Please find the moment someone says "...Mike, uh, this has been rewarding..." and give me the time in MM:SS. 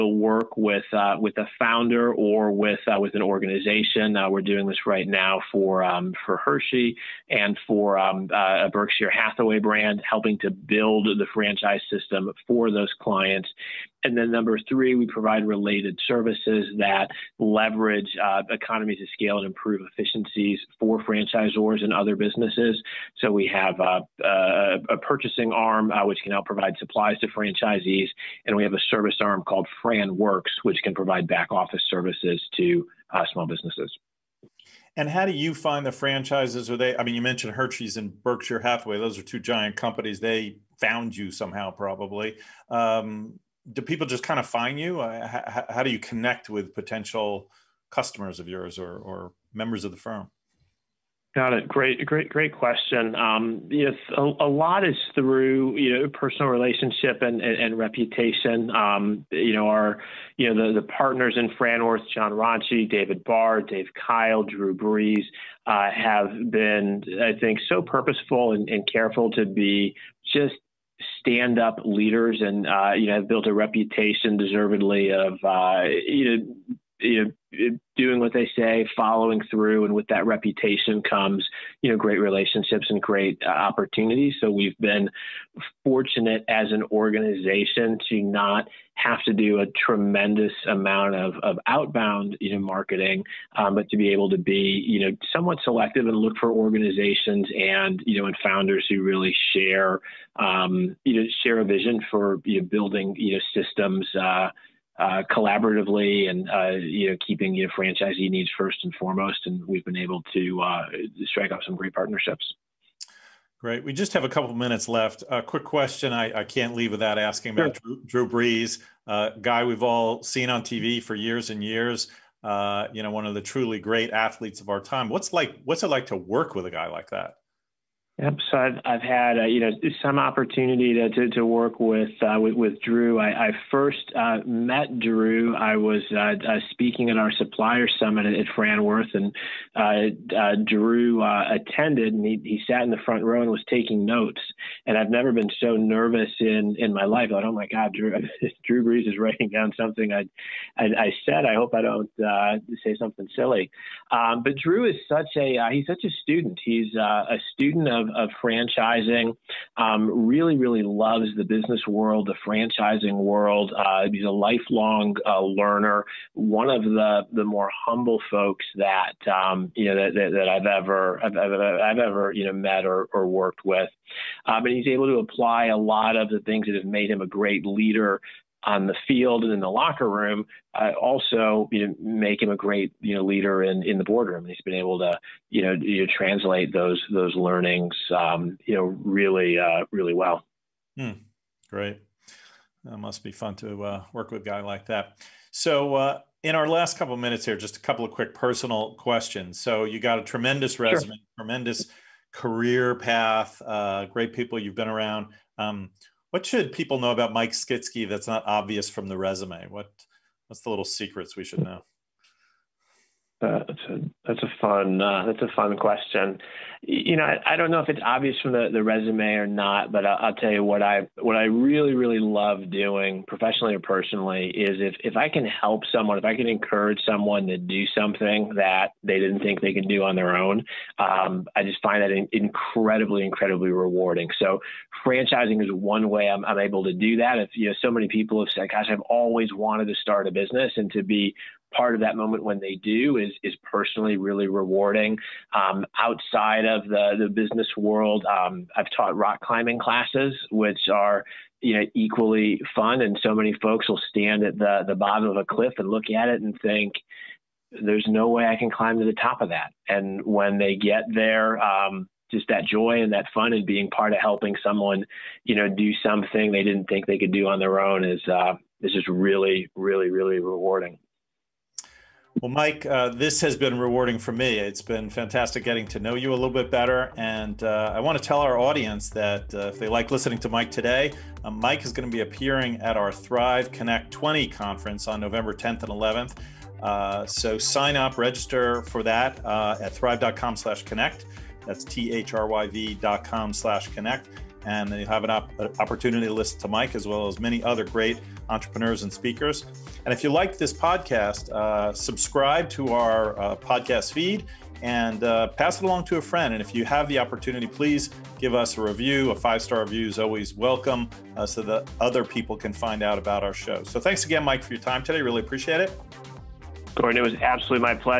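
04:32.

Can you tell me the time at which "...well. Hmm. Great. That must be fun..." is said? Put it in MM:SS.
03:10.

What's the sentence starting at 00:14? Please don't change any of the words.
And then number three, we provide related services that leverage uh, economies of scale and improve efficiencies for franchisors and other businesses.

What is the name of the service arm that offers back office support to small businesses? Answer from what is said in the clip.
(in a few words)
FranWorks.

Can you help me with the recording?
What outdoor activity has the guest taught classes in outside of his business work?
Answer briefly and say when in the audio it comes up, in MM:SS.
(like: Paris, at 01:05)
rock climbing, at 04:09.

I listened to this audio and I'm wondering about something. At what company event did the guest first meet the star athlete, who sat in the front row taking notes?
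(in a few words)
supplier summit.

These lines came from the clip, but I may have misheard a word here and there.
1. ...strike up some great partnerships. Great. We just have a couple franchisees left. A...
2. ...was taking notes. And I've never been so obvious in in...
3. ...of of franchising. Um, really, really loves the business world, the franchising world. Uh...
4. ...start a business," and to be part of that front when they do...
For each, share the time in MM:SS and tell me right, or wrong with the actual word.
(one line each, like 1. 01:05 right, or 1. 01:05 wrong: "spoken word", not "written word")
1. 01:51 wrong: "minutes", not "franchisees"
2. 02:23 wrong: "nervous", not "obvious"
3. 02:37 right
4. 03:59 wrong: "moment", not "front".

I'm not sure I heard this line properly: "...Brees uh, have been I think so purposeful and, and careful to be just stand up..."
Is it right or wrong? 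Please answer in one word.
right.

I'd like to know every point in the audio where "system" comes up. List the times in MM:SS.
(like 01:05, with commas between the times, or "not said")
00:11, 01:43.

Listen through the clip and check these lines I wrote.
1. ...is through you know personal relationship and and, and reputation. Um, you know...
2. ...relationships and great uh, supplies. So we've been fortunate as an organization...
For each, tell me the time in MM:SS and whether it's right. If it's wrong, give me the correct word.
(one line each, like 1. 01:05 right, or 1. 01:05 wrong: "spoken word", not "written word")
1. 00:54 right
2. 01:22 wrong: "opportunities", not "supplies".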